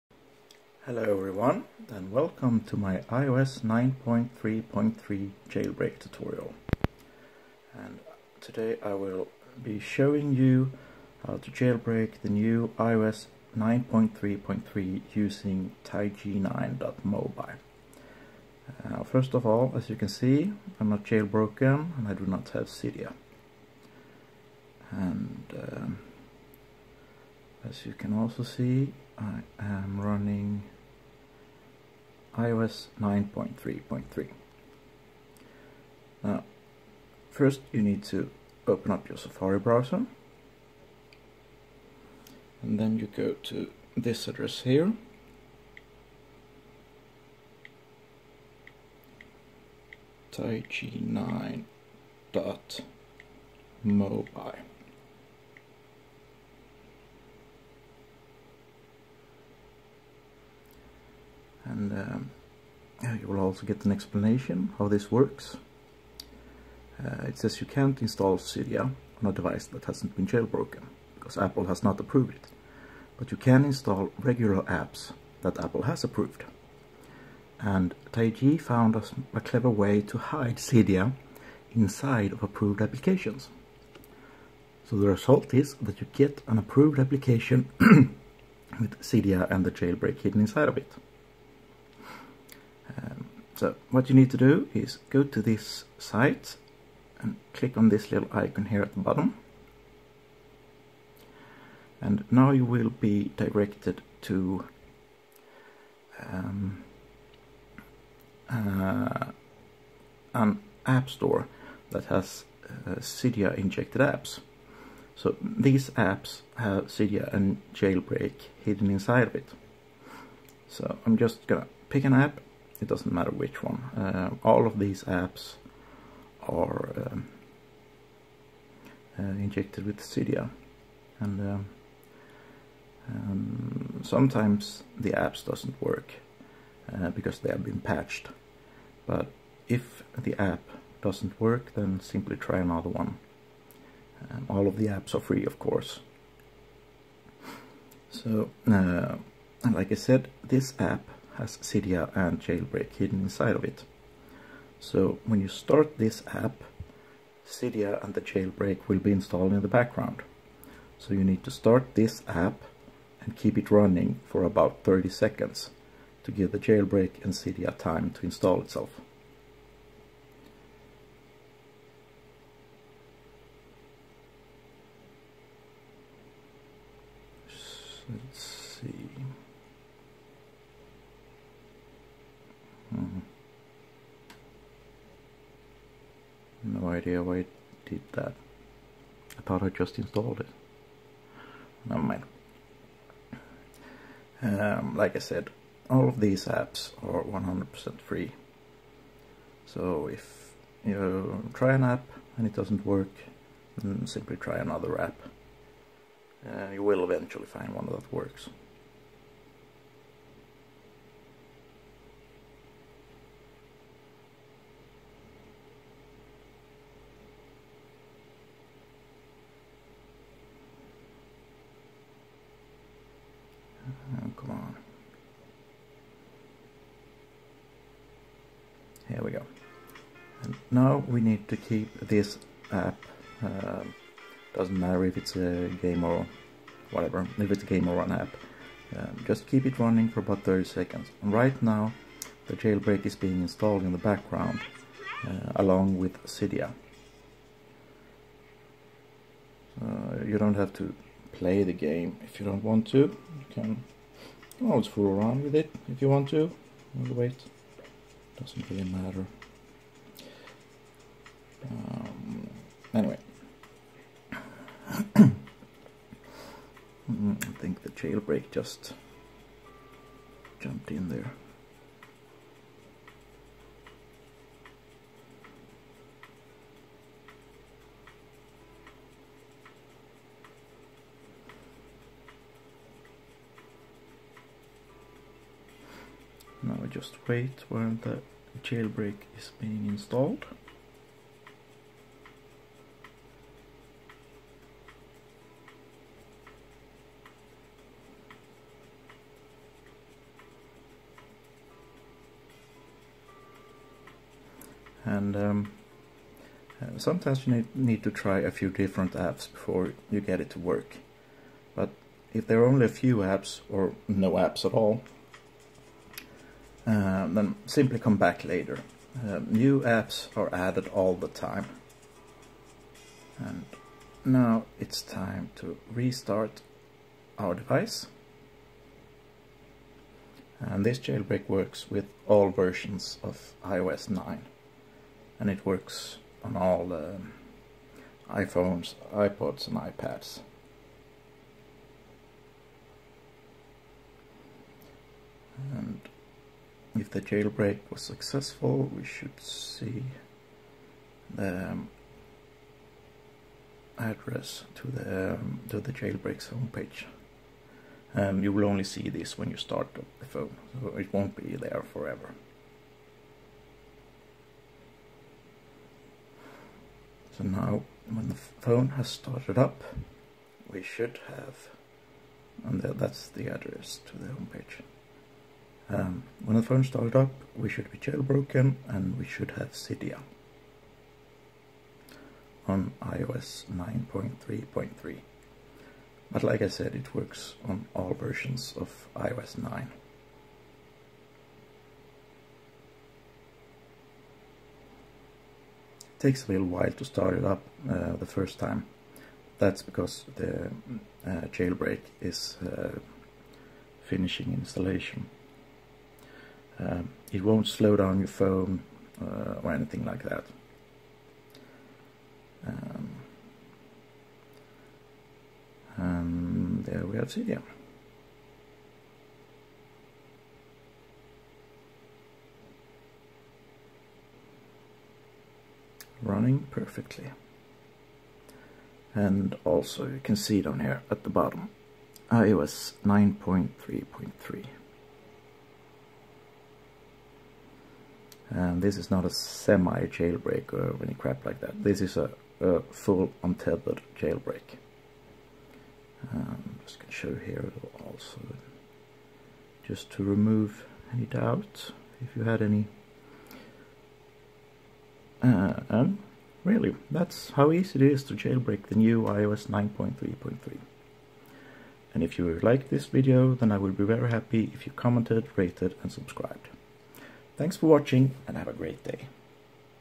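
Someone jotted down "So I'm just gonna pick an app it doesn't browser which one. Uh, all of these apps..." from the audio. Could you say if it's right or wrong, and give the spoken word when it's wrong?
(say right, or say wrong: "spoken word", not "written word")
wrong: "matter", not "browser".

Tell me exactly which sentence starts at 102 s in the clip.
And now you will be directed to um, uh, an app store that has uh, Cydia injected apps.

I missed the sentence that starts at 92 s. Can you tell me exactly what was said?
Um, so what you need to do is go to this site and click on this little icon here at the bottom.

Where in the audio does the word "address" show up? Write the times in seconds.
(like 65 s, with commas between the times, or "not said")
44 s, 353 s, 373 s.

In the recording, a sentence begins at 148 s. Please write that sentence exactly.
So uh, like I said this app has Cydia and Jailbreak hidden inside of it.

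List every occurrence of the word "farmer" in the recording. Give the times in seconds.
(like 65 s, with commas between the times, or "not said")
not said.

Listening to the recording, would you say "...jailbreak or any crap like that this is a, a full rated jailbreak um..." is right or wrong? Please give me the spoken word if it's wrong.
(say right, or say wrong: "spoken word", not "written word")
wrong: "untethered", not "rated".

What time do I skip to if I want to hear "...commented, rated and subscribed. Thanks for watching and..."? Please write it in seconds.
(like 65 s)
464 s.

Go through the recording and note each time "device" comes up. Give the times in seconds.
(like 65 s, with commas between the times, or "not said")
69 s, 327 s.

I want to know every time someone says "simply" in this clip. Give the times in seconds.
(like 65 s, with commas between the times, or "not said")
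141 s, 204 s, 317 s.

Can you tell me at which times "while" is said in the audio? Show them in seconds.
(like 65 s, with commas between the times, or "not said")
287 s, 396 s.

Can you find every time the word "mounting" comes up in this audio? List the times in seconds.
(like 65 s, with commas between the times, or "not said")
not said.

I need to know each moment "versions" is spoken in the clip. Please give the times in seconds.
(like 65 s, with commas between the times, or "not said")
332 s, 388 s.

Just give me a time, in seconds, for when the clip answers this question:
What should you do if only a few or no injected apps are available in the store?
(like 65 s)
317 s.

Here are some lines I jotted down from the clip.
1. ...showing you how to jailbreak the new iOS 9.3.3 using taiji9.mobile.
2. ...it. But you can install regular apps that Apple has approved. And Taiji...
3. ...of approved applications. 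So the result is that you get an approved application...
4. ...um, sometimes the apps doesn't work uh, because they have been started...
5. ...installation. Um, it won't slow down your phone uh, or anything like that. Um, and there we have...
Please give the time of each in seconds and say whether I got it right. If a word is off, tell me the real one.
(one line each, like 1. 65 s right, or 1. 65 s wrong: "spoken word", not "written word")
1. 9 s right
2. 72 s right
3. 82 s right
4. 133 s wrong: "patched", not "started"
5. 404 s right.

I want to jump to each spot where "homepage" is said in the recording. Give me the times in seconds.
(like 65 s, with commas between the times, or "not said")
356 s, 374 s.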